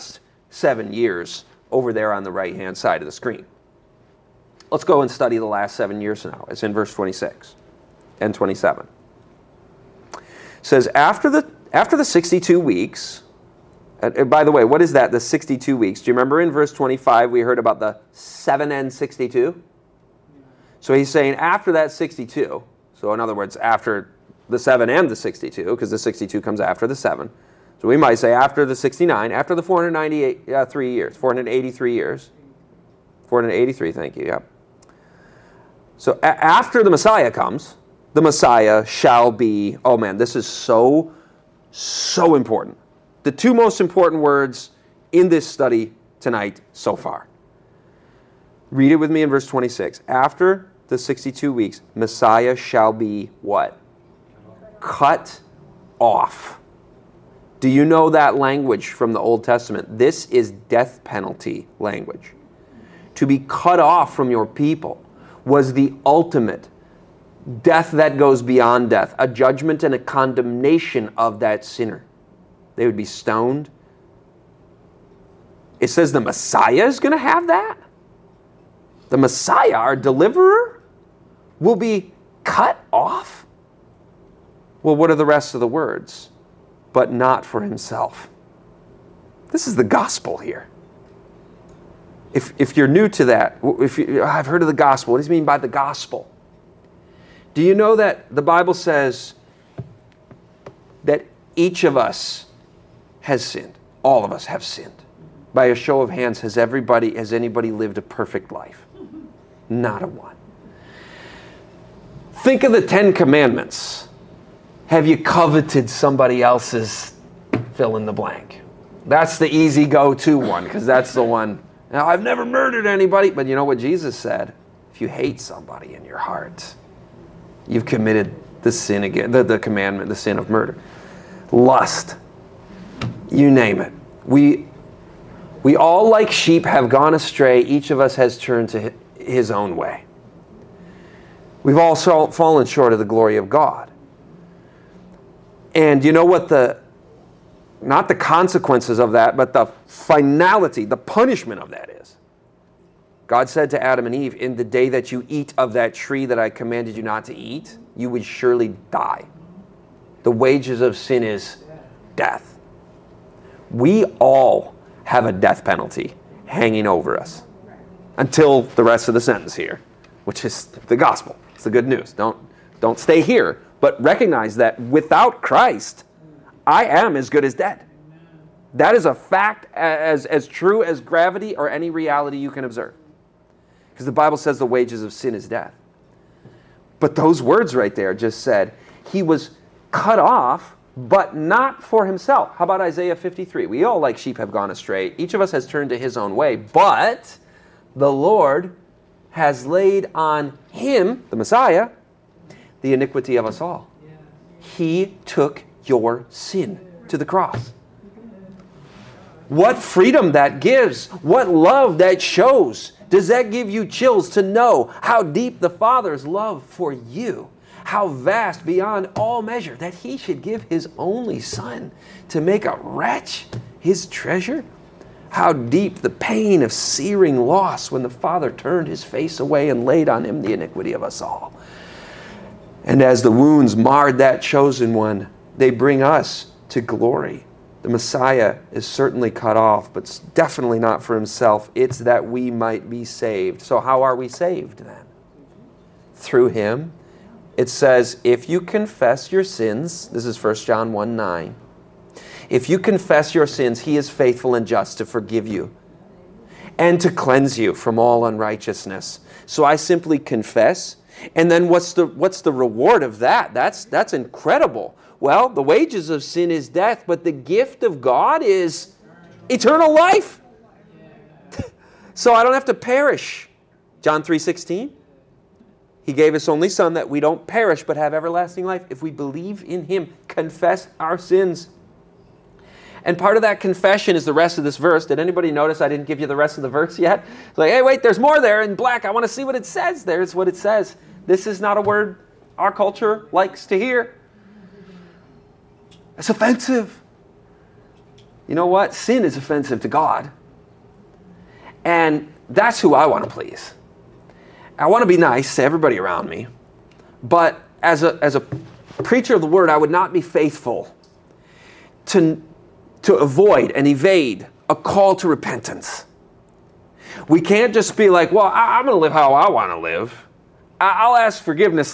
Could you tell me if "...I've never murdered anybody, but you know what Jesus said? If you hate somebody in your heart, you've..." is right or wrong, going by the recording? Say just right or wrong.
right.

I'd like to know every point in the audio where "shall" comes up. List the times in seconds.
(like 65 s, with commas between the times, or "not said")
38 s, 52 s.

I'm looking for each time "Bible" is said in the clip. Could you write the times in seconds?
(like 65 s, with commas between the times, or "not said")
98 s, 184 s.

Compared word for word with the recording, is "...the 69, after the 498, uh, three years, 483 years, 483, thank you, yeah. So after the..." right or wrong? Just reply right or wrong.
right.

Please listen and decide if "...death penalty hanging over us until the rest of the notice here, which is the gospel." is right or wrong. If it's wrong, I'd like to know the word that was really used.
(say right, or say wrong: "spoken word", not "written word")
wrong: "sentence", not "notice".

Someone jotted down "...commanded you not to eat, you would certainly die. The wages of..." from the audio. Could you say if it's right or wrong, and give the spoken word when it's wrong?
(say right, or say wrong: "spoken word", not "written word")
wrong: "surely", not "certainly".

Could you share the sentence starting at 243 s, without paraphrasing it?
So, how are we saved then?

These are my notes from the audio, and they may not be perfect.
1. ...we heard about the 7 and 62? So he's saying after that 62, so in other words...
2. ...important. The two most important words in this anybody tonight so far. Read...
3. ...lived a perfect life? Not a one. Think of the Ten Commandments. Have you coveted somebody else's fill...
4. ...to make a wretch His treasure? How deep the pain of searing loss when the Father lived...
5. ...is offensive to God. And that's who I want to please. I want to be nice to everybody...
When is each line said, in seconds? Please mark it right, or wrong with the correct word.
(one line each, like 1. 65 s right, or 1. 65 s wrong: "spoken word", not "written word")
1. 17 s right
2. 42 s wrong: "study", not "anybody"
3. 107 s right
4. 222 s wrong: "turned", not "lived"
5. 299 s right.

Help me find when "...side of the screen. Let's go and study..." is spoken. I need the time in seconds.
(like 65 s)
2 s.